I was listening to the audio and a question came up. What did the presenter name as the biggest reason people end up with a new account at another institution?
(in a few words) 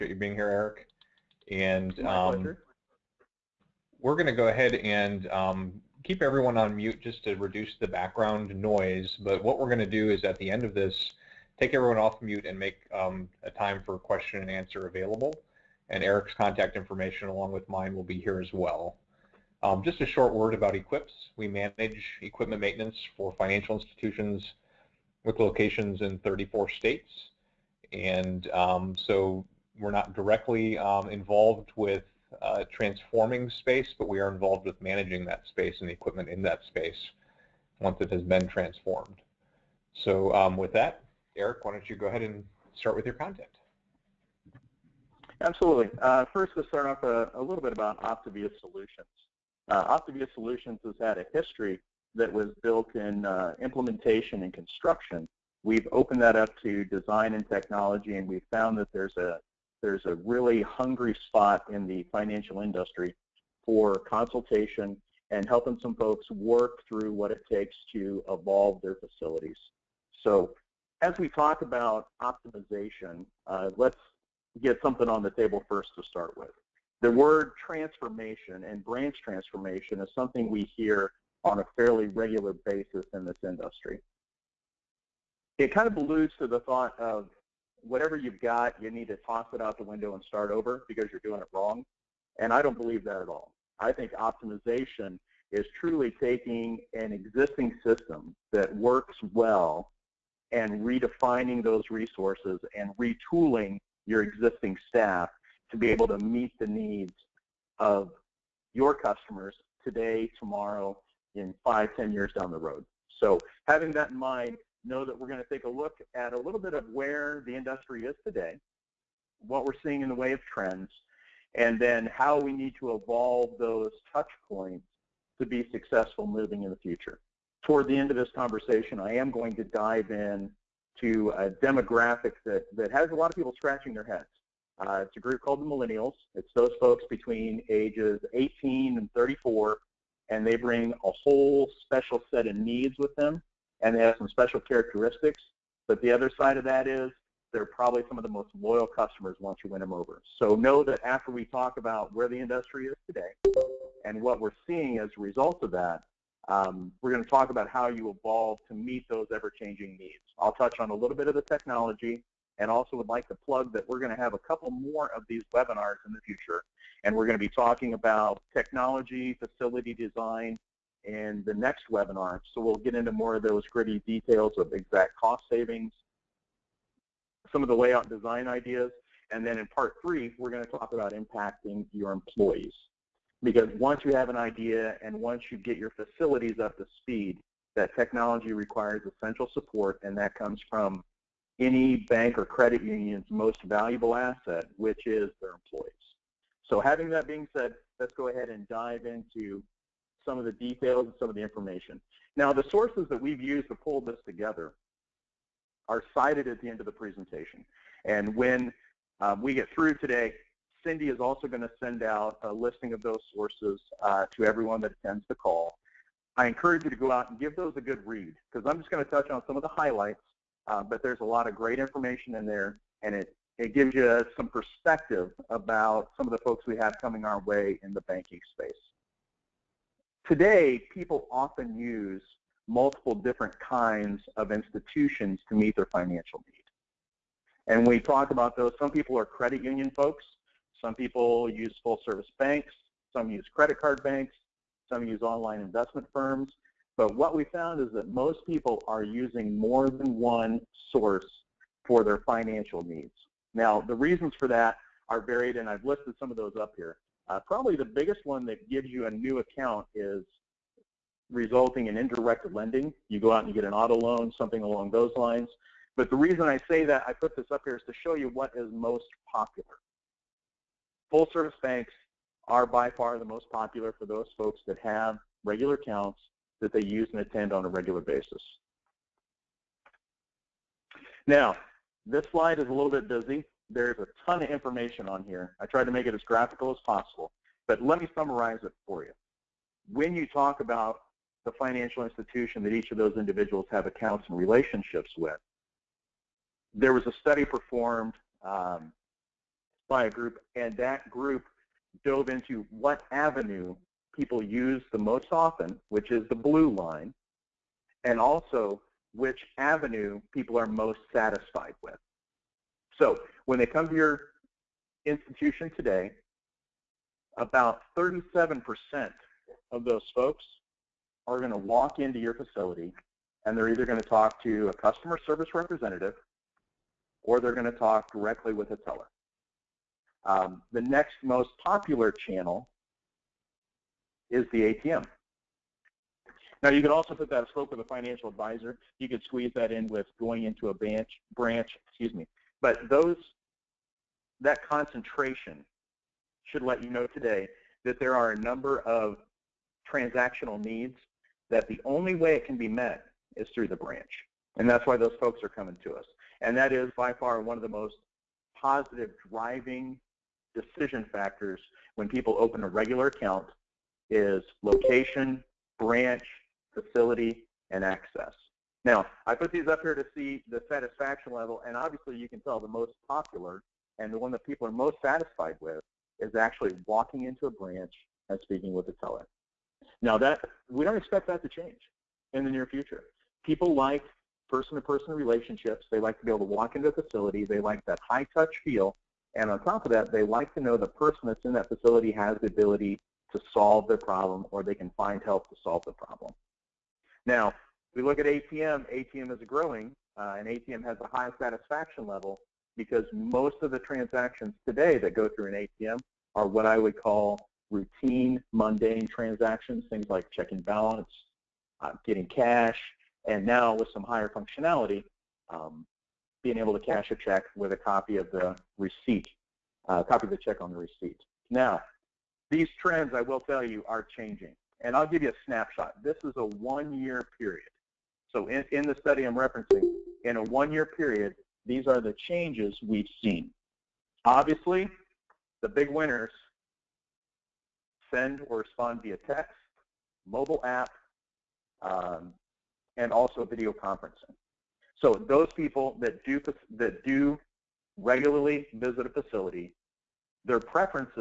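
Indirect lending.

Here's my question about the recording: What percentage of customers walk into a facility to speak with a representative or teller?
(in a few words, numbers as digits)
37%.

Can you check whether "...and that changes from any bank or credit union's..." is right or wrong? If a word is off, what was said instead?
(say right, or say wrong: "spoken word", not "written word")
wrong: "comes", not "changes".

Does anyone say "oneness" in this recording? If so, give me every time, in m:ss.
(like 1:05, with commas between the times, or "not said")
not said.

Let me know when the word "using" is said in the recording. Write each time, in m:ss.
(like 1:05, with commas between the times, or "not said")
4:09.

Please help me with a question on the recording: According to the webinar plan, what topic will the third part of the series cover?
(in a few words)
Impacting your employees.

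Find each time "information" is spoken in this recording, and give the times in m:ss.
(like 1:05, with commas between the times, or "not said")
0:16, 3:21, 3:41, 4:44.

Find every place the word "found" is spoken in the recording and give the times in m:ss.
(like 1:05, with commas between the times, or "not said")
0:58, 4:07.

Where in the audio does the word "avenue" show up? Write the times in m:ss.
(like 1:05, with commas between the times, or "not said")
5:03, 5:09.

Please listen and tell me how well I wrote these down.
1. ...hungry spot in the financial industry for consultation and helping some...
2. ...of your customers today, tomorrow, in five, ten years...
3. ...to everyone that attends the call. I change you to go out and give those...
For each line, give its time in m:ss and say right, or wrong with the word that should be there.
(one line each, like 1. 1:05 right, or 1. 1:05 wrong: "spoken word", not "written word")
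1. 1:00 right
2. 1:47 right
3. 3:34 wrong: "encourage", not "change".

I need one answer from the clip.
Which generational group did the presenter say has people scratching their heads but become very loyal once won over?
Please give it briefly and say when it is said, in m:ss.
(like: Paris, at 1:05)
Millennials, at 2:15.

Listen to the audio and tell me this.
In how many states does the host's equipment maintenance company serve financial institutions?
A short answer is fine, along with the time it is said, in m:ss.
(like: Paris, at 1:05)
34, at 0:26.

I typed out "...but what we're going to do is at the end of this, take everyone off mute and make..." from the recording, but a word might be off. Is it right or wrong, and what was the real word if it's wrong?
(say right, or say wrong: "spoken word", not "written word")
right.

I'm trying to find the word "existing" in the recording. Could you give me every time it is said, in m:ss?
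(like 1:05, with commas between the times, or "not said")
1:37, 1:44.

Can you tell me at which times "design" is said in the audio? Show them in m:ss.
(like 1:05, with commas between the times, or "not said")
0:56, 2:49, 2:58.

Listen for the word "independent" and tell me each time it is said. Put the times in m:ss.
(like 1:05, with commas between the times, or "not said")
not said.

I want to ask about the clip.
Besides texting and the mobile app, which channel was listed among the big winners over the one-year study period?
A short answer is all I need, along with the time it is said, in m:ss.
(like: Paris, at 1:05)
Video conferencing, at 7:23.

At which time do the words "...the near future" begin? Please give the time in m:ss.
6:22.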